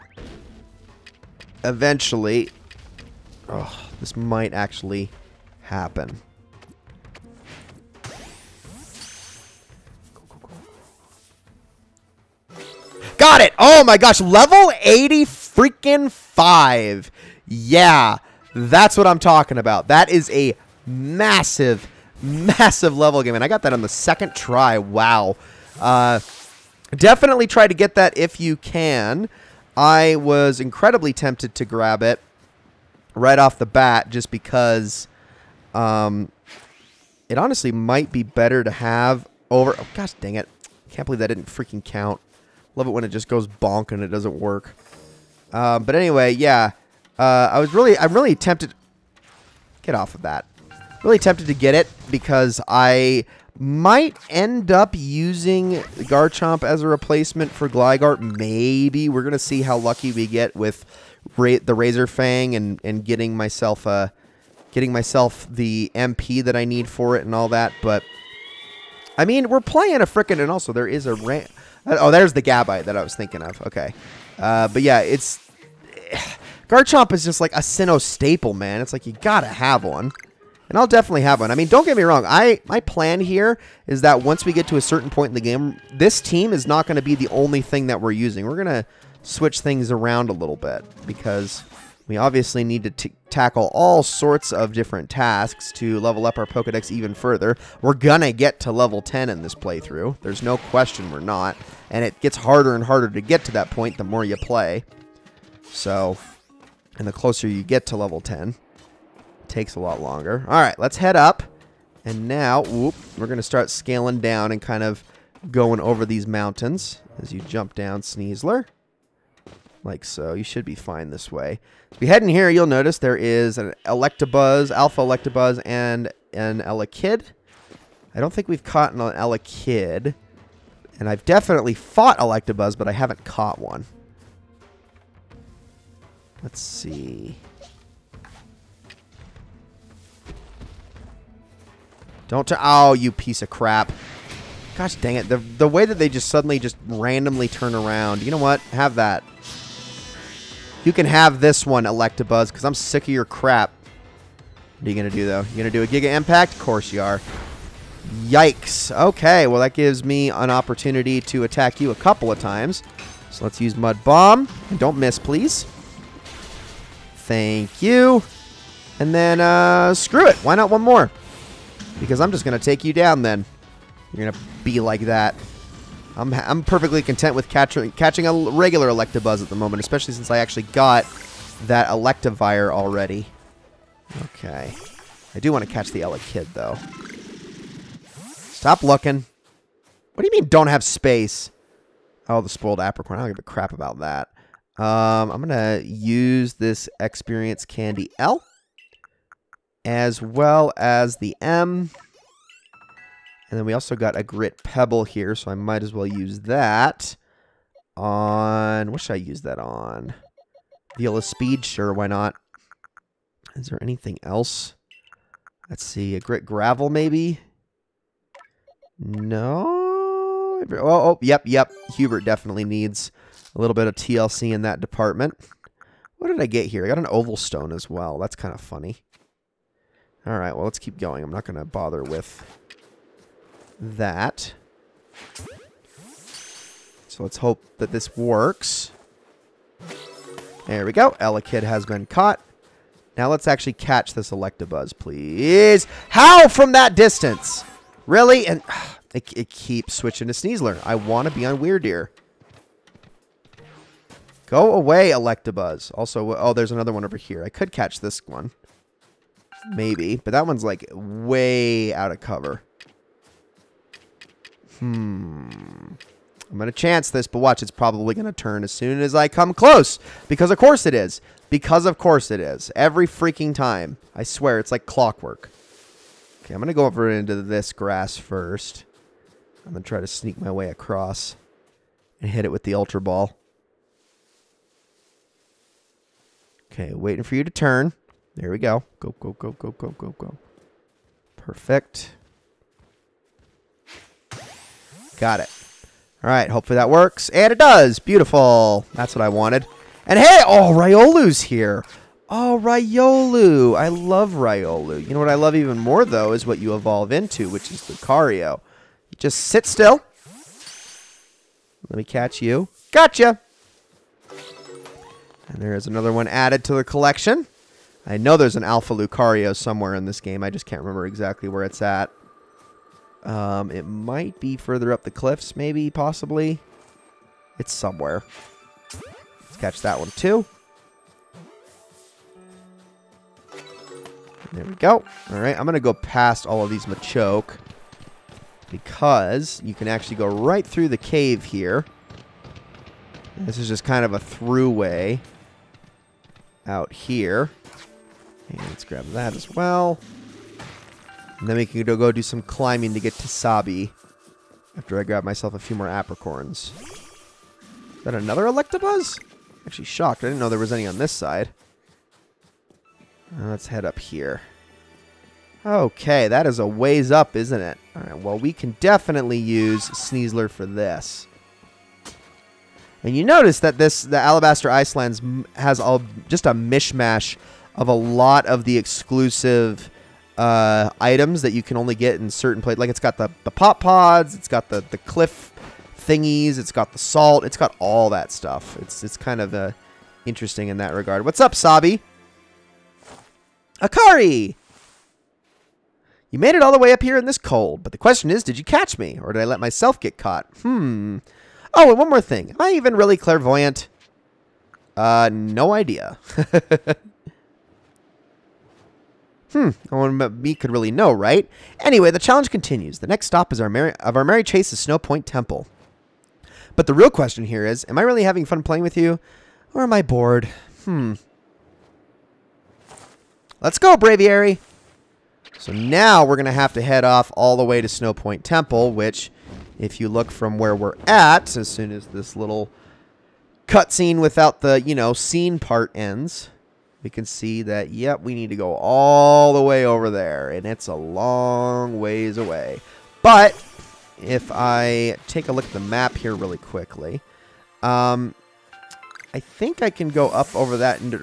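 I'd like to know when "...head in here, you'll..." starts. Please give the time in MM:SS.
02:02.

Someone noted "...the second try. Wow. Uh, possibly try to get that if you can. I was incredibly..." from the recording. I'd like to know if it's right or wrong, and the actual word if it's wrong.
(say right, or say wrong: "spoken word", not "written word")
wrong: "definitely", not "possibly".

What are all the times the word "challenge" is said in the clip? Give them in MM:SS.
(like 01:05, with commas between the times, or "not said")
06:52.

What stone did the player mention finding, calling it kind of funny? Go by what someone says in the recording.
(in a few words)
oval stone.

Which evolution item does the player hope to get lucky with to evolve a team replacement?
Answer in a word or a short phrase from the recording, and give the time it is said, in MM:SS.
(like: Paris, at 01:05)
Razor Fang, at 01:01.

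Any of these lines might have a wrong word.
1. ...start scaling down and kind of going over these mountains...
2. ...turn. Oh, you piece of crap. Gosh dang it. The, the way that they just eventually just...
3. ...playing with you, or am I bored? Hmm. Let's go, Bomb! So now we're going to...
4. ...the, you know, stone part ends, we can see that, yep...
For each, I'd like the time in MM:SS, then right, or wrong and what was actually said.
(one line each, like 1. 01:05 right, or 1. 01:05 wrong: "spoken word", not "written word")
1. 01:53 right
2. 02:22 wrong: "suddenly", not "eventually"
3. 06:58 wrong: "Braviary", not "Bomb"
4. 07:14 wrong: "scene", not "stone".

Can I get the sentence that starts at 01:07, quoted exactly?
But, I mean, we're playing a frickin' and also there is a ramp.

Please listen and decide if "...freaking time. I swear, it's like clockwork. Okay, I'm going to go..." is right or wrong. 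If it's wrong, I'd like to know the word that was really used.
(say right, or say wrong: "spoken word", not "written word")
right.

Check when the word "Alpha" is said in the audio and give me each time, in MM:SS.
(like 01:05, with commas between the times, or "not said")
02:04, 05:18.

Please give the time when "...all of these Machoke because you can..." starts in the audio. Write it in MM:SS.
05:36.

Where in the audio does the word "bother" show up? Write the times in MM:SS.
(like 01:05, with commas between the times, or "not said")
03:51.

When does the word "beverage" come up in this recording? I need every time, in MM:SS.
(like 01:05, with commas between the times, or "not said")
not said.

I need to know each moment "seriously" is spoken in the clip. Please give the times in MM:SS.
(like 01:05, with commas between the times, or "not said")
not said.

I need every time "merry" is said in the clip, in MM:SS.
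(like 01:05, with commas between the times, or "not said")
06:54.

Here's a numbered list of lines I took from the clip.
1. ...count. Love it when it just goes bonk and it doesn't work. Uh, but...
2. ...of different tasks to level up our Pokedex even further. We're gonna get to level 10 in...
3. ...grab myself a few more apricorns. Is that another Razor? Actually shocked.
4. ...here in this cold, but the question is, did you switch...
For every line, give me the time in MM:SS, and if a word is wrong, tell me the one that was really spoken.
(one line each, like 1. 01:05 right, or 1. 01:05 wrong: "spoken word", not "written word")
1. 00:41 right
2. 01:34 right
3. 05:55 wrong: "Electabuzz", not "Razor"
4. 06:37 wrong: "catch", not "switch".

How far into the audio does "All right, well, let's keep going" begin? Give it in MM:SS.
03:50.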